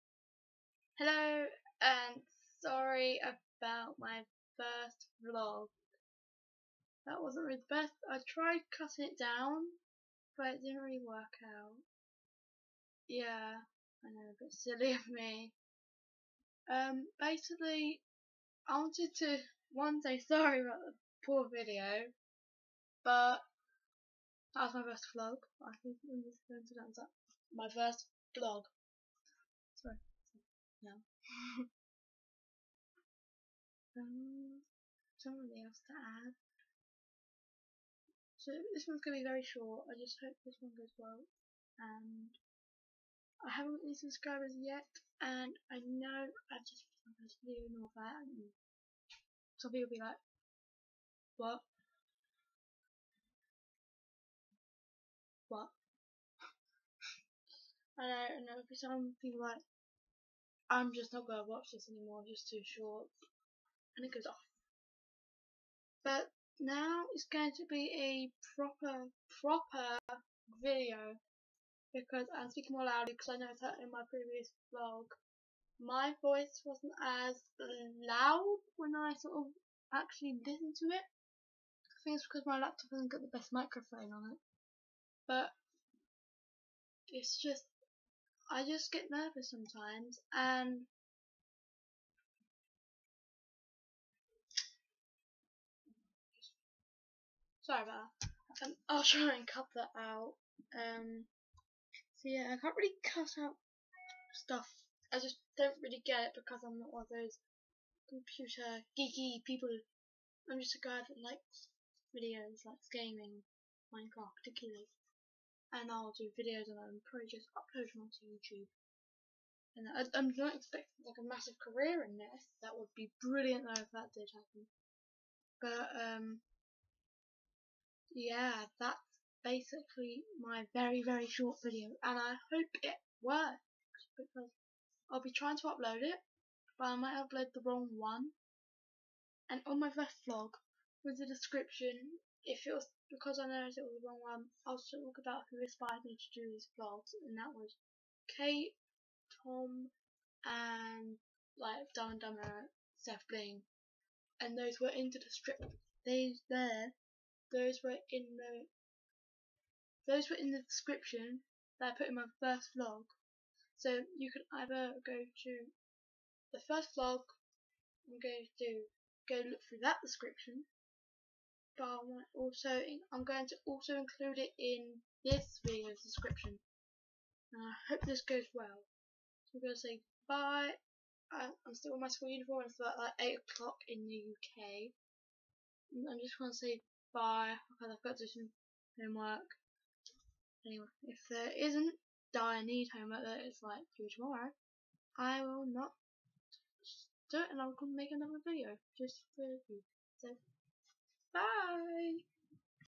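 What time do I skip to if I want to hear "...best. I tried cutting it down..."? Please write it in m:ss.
0:07.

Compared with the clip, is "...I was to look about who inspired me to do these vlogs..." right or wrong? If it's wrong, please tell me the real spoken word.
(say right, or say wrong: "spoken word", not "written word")
right.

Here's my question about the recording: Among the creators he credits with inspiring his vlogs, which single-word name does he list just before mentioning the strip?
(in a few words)
SethBling.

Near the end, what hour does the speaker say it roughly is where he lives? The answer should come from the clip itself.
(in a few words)
8 o'clock.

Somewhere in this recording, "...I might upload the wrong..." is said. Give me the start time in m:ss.
2:16.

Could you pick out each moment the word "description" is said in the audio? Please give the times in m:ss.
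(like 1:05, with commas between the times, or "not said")
2:21, 2:40, 2:50, 2:56.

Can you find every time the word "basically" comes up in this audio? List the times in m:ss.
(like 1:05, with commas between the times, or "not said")
0:17, 2:09.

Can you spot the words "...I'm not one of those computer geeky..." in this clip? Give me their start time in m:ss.
1:46.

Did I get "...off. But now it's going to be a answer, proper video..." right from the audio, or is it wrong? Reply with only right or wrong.
wrong.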